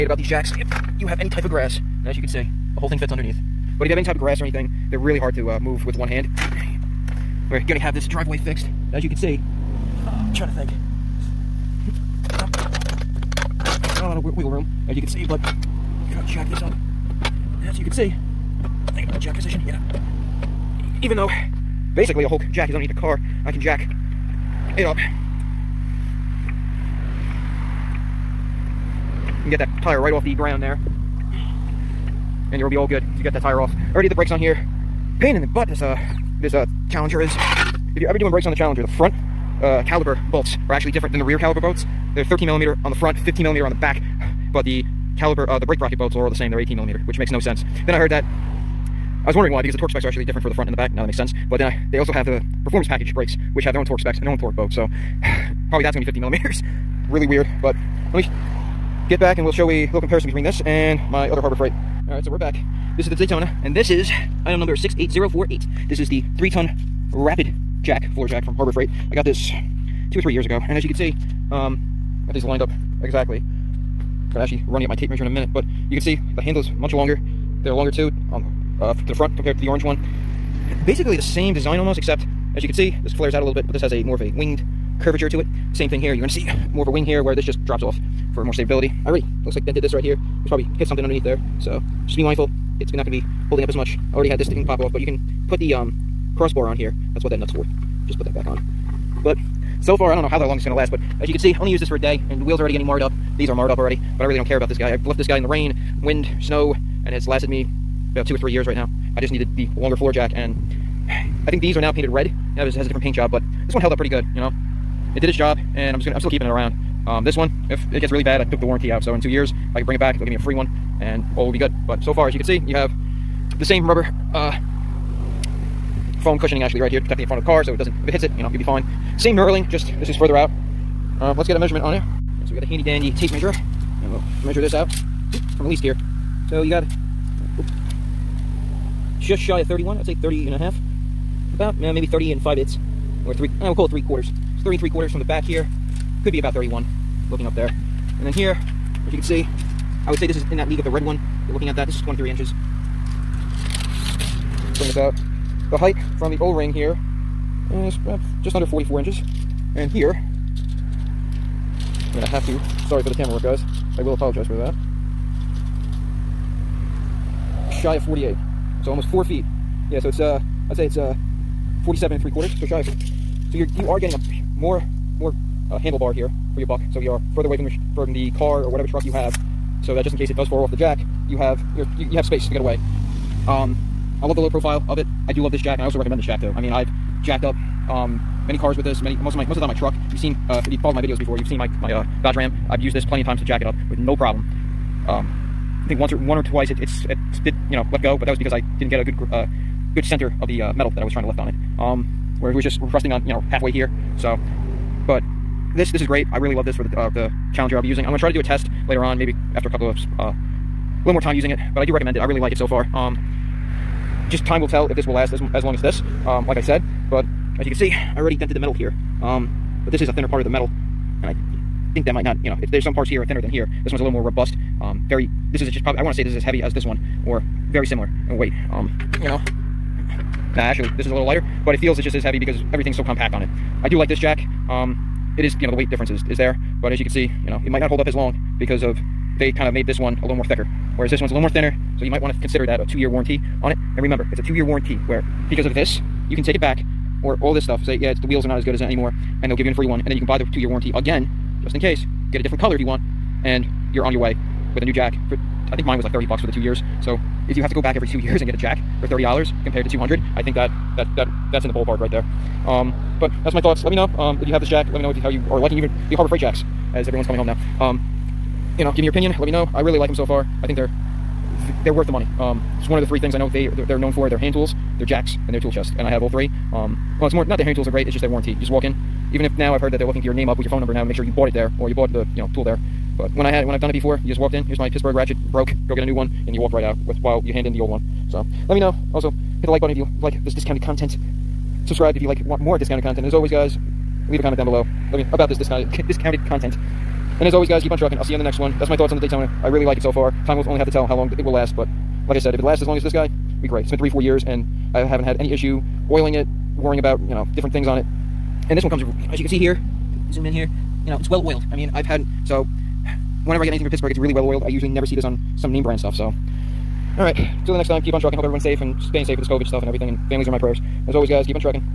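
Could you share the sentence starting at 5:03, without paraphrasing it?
It's been three, four years, and I haven't had any issue oiling it, worrying about, you know, different things on it.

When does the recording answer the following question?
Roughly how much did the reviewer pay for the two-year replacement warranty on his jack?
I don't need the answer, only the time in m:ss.
4:16.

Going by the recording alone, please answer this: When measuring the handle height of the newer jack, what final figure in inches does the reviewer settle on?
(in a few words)
47 3/4 inches.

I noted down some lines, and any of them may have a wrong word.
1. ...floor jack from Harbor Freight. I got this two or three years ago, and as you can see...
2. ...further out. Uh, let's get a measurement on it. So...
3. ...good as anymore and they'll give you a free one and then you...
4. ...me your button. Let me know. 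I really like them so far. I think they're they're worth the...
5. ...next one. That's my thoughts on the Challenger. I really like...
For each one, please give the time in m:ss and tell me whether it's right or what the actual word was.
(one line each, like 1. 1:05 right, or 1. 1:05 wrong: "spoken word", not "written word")
1. 1:08 right
2. 2:10 right
3. 4:08 right
4. 4:29 wrong: "opinion", not "button"
5. 4:58 wrong: "Daytona", not "Challenger".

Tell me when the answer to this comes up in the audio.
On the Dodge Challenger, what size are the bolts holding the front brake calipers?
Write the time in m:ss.
0:42.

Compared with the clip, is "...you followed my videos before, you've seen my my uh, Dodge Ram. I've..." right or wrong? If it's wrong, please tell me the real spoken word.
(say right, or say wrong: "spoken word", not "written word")
right.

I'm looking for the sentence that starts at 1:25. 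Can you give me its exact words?
Same thing here, you're gonna see more of a wing here where this just drops off for more stability.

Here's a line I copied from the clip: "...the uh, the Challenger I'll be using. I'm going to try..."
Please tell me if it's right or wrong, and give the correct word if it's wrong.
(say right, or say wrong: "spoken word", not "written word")
right.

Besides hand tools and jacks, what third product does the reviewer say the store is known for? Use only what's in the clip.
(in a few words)
tool chest.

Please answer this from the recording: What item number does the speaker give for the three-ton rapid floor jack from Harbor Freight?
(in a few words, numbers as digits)
68048.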